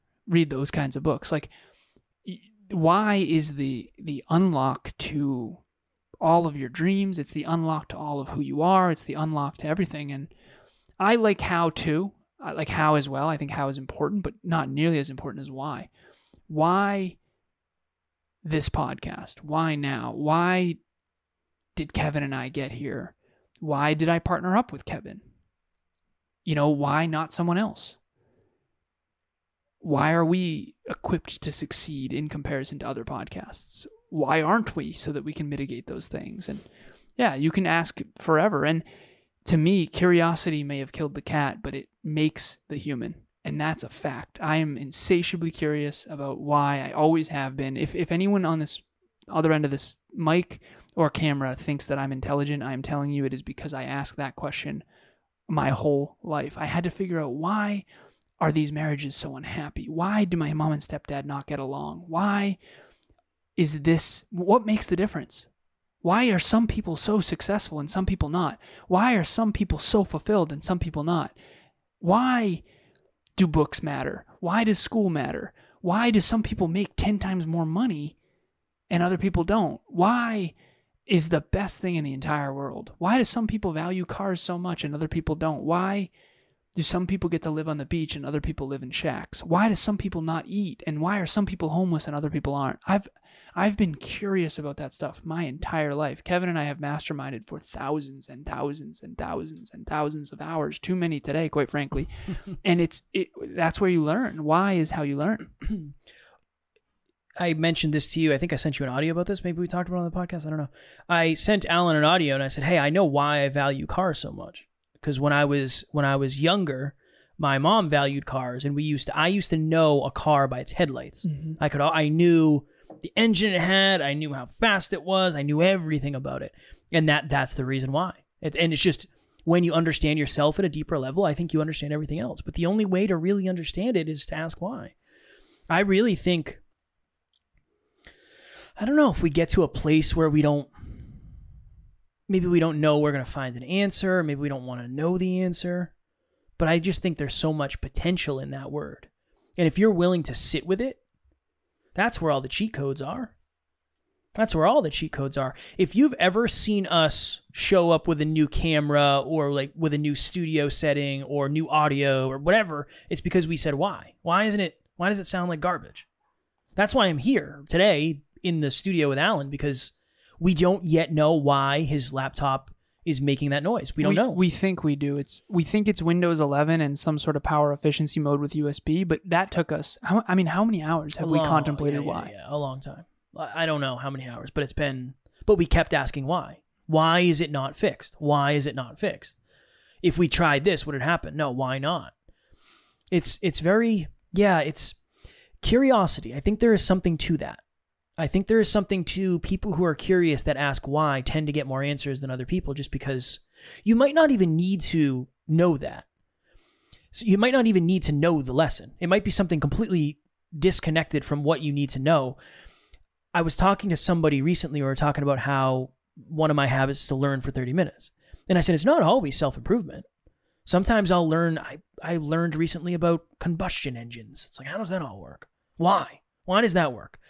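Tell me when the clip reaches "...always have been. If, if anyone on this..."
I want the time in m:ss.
0:46.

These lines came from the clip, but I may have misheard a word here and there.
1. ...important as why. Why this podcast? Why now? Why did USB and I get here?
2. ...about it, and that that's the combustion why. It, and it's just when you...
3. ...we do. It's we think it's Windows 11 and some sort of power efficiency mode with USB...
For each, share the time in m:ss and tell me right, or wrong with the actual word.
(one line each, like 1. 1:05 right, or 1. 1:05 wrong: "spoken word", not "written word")
1. 0:15 wrong: "Kevin", not "USB"
2. 2:06 wrong: "reason", not "combustion"
3. 2:54 right.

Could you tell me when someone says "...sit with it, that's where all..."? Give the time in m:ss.
2:30.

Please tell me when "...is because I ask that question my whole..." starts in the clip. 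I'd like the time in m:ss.
0:53.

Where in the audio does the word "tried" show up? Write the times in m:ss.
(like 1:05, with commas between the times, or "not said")
3:10.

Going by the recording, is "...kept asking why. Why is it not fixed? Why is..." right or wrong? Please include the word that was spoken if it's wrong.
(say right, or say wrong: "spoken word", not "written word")
right.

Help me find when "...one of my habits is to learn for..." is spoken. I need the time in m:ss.
3:36.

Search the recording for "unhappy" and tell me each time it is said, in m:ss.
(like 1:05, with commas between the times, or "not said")
0:59.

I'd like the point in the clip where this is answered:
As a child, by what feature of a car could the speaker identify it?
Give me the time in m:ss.
2:00.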